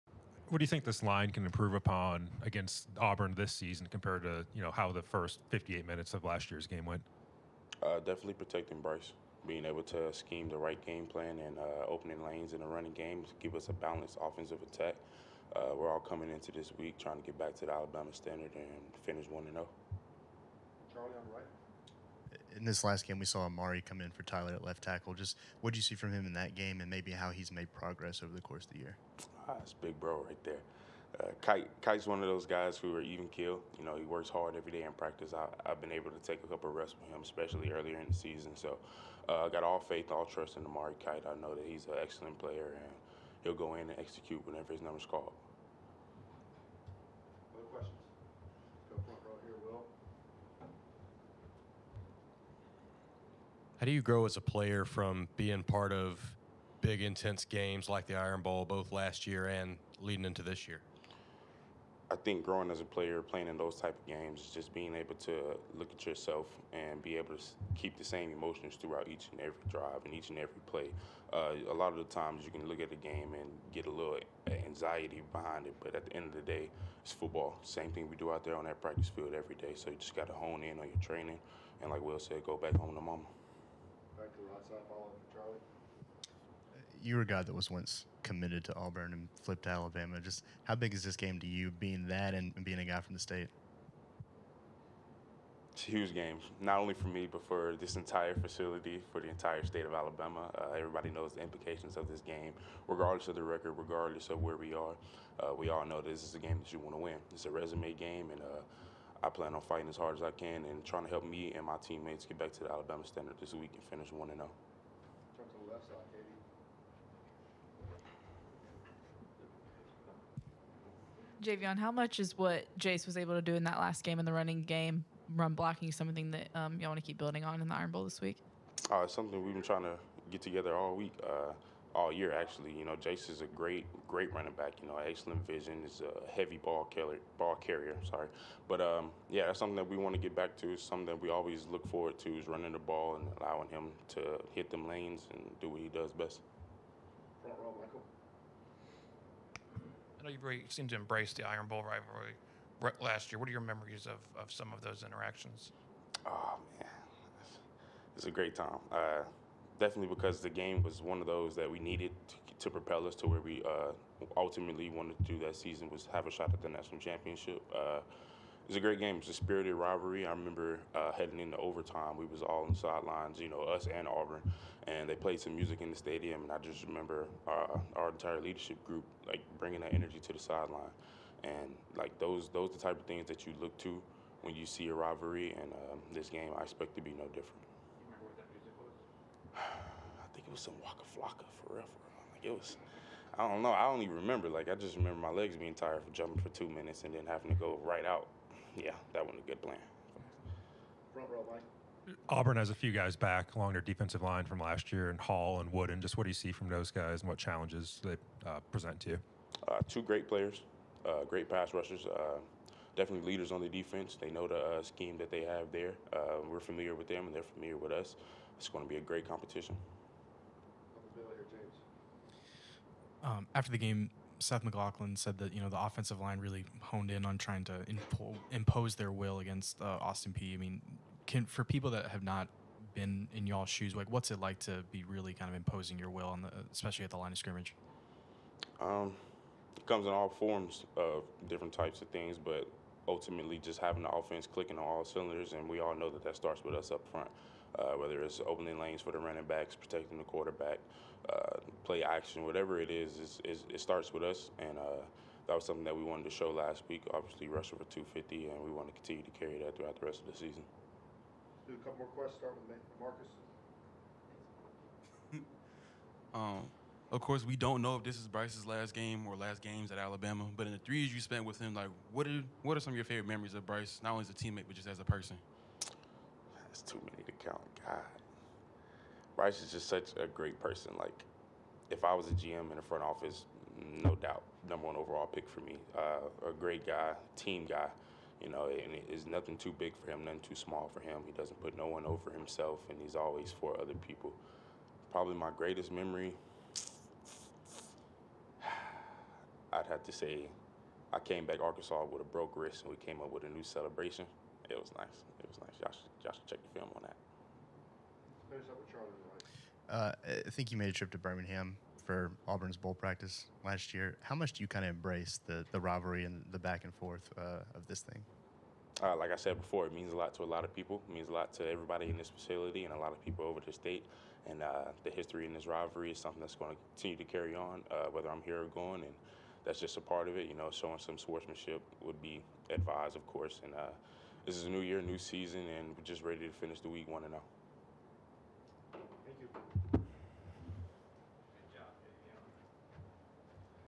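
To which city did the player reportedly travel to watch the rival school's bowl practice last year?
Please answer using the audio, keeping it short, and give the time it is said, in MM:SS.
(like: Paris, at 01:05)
Birmingham, at 05:11.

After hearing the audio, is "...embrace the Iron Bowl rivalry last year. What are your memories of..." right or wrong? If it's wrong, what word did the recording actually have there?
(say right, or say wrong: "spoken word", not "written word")
right.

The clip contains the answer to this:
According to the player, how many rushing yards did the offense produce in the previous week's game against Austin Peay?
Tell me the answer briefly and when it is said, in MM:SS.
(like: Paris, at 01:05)
250, at 04:17.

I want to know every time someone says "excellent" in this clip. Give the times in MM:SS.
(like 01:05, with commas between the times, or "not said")
00:42, 02:14.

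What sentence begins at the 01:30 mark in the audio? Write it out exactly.
Just how big is this game to you, being that and, being a guy from the state?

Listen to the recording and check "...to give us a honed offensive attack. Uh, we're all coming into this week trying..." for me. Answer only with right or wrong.
wrong.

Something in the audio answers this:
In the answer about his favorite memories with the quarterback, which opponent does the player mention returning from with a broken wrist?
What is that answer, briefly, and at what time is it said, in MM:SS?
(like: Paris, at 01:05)
Arkansas, at 05:01.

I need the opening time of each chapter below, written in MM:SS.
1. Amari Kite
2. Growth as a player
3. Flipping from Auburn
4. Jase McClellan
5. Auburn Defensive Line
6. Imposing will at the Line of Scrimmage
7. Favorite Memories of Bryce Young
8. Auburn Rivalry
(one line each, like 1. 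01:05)
1. 00:22
2. 00:54
3. 01:27
4. 02:00
5. 03:23
6. 03:45
7. 04:25
8. 05:10.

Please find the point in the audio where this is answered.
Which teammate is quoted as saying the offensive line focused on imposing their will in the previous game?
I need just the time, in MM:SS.
03:44.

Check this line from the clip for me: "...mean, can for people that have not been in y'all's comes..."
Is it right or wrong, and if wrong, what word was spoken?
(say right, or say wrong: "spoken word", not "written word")
wrong: "shoes", not "comes".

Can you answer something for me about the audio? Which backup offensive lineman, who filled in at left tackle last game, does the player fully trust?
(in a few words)
Amari Kite.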